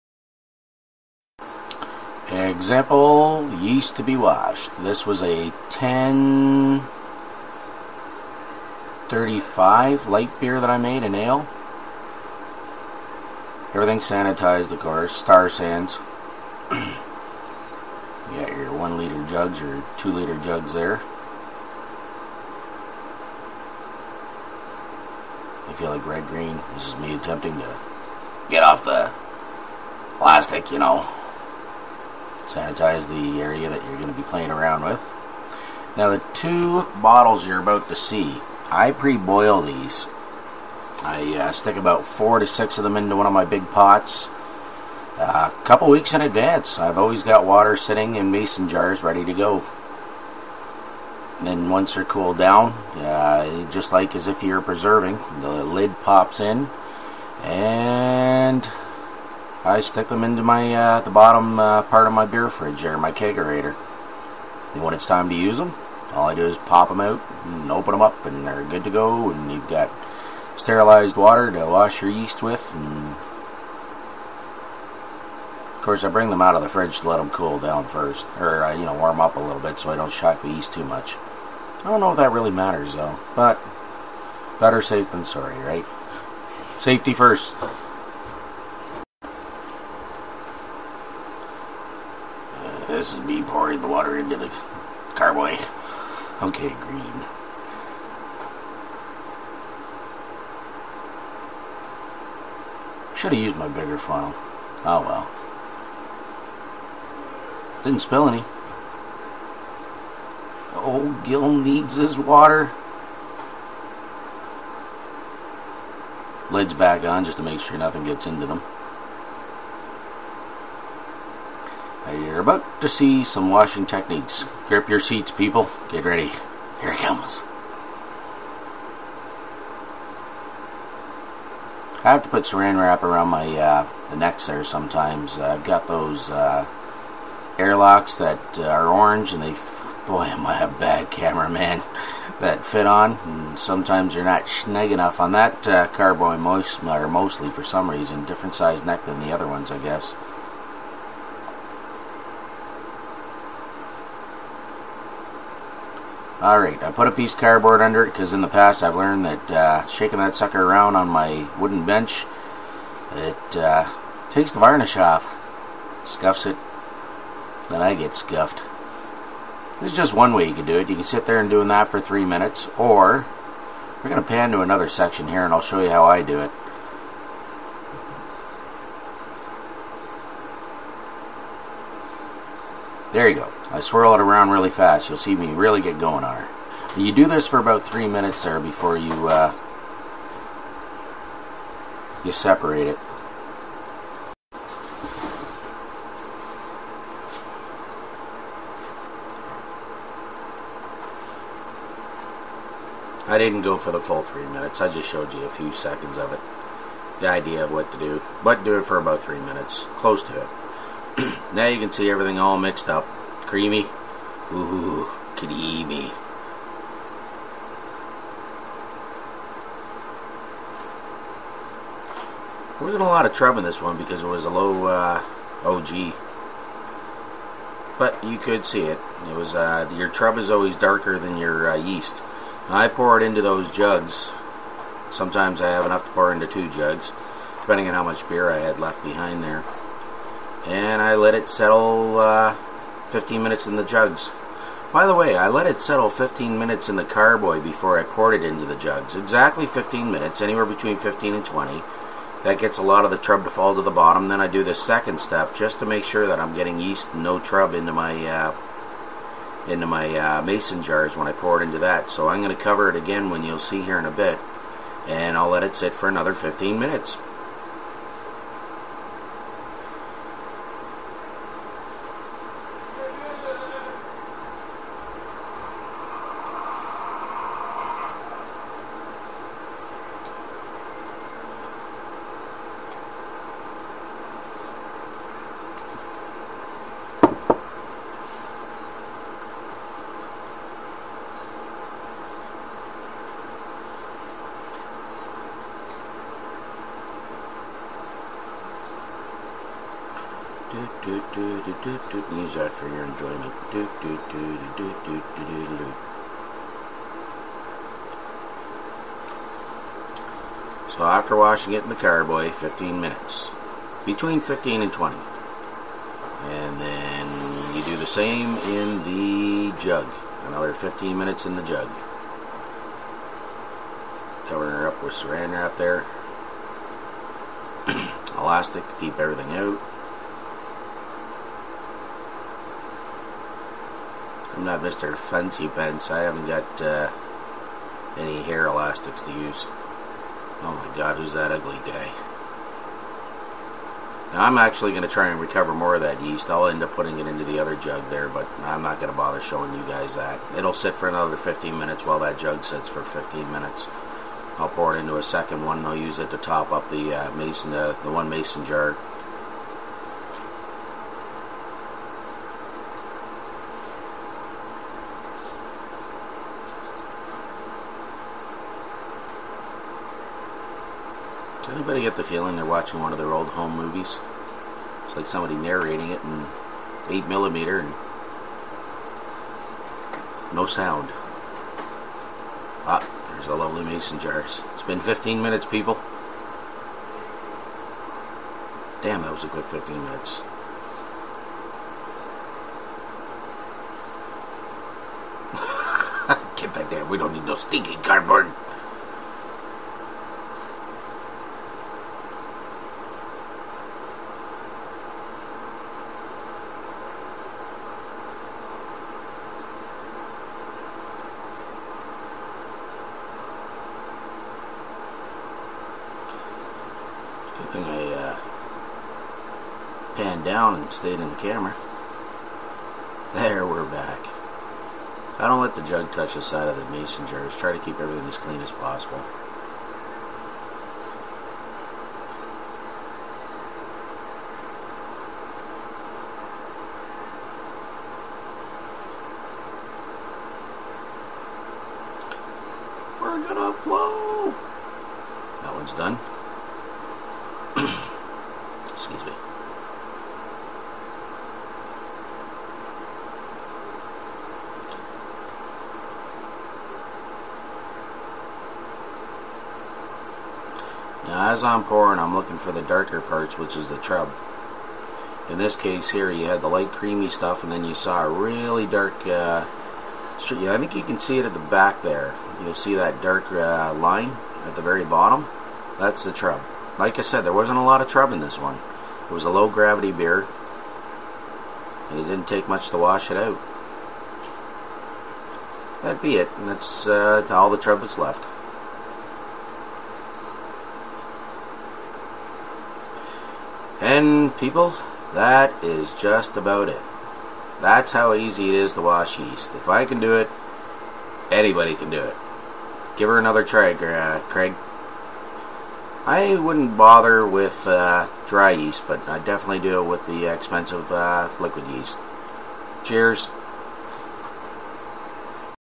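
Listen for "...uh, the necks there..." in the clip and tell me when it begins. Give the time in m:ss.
2:13.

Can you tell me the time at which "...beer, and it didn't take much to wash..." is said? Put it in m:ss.
8:00.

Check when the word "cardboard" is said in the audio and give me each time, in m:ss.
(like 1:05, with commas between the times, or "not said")
2:37, 6:38.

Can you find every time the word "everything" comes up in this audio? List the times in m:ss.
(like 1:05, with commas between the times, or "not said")
0:13, 3:32, 5:29, 7:07.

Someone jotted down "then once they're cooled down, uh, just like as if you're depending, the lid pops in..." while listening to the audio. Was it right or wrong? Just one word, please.
wrong.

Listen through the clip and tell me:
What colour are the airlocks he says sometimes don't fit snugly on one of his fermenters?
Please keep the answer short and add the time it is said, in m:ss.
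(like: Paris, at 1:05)
Orange, at 2:18.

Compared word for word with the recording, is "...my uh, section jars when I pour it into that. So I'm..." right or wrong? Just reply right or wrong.
wrong.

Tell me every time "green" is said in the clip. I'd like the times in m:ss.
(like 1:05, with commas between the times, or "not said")
0:26, 1:36.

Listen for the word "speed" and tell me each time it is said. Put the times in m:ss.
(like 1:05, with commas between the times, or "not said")
not said.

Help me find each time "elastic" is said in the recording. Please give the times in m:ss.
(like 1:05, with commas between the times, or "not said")
5:28, 5:38.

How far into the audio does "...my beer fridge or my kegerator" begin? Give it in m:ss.
1:02.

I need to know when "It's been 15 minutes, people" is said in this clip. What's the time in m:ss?
6:24.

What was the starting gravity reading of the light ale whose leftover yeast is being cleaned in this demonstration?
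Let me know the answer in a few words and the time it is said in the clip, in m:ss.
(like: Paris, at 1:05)
1035, at 0:05.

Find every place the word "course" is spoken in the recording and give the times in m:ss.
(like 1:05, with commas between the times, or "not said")
0:14, 1:15.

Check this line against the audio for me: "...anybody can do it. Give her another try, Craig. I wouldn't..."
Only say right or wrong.
right.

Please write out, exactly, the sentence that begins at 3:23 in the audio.
I didn't go for the full three minutes.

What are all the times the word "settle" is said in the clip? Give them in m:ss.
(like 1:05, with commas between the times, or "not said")
4:01, 4:05.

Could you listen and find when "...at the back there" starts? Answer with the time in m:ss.
7:51.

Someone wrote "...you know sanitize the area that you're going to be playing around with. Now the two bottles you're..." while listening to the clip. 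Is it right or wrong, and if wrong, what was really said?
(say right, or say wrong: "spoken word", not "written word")
right.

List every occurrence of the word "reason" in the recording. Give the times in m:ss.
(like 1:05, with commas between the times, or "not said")
2:27.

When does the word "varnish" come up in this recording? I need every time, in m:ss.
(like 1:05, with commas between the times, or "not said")
2:44.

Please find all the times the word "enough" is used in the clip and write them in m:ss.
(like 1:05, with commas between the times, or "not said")
2:24, 3:55.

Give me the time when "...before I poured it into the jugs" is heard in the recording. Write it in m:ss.
4:07.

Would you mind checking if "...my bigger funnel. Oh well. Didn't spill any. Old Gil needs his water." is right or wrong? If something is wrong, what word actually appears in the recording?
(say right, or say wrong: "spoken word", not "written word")
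right.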